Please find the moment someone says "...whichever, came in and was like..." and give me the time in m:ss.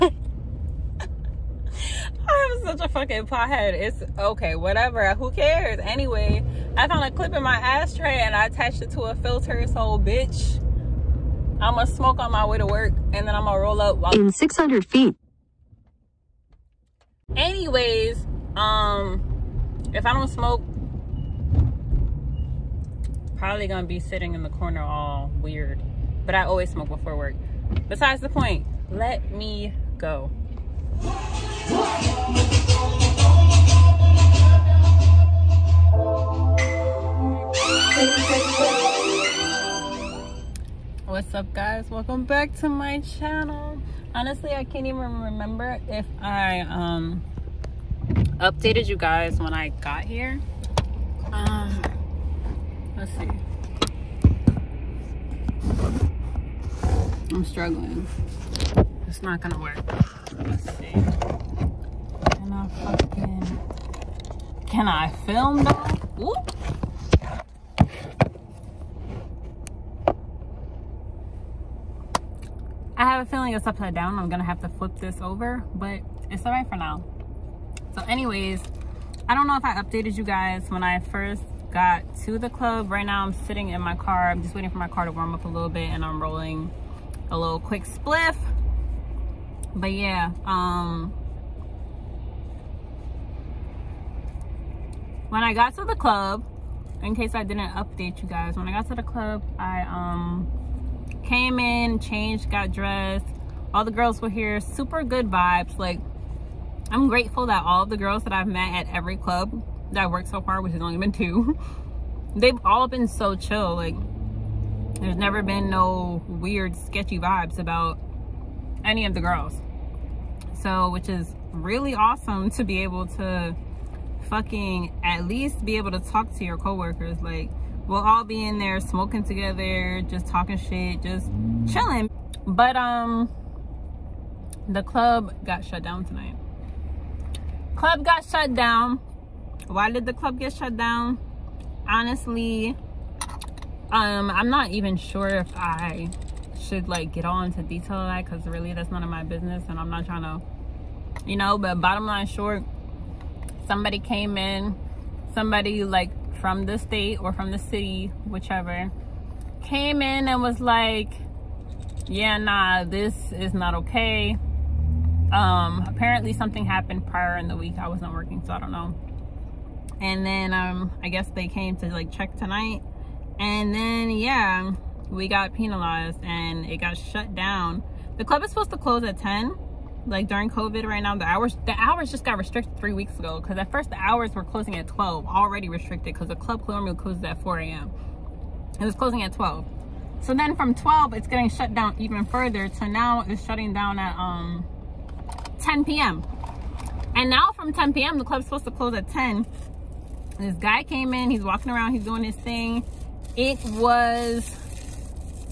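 2:38.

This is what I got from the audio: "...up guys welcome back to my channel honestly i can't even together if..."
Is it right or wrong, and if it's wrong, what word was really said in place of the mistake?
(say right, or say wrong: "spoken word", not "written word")
wrong: "remember", not "together".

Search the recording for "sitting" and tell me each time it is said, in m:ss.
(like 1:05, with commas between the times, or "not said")
0:24, 1:23.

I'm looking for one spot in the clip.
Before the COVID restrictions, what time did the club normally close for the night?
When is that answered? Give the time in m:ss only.
3:07.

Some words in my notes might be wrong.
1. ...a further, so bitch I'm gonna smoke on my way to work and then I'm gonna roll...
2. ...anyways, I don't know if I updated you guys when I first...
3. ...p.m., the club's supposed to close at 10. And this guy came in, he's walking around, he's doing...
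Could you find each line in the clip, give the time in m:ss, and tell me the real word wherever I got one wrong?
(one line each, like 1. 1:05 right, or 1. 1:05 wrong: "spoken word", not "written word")
1. 0:09 wrong: "filter", not "further"
2. 1:18 right
3. 3:17 right.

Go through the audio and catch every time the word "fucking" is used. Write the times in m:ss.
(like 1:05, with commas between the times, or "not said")
0:02, 1:02, 2:04.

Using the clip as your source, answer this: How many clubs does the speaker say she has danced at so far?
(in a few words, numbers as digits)
2.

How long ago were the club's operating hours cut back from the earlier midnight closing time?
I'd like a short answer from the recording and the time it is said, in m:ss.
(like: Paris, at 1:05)
3 weeks ago, at 3:02.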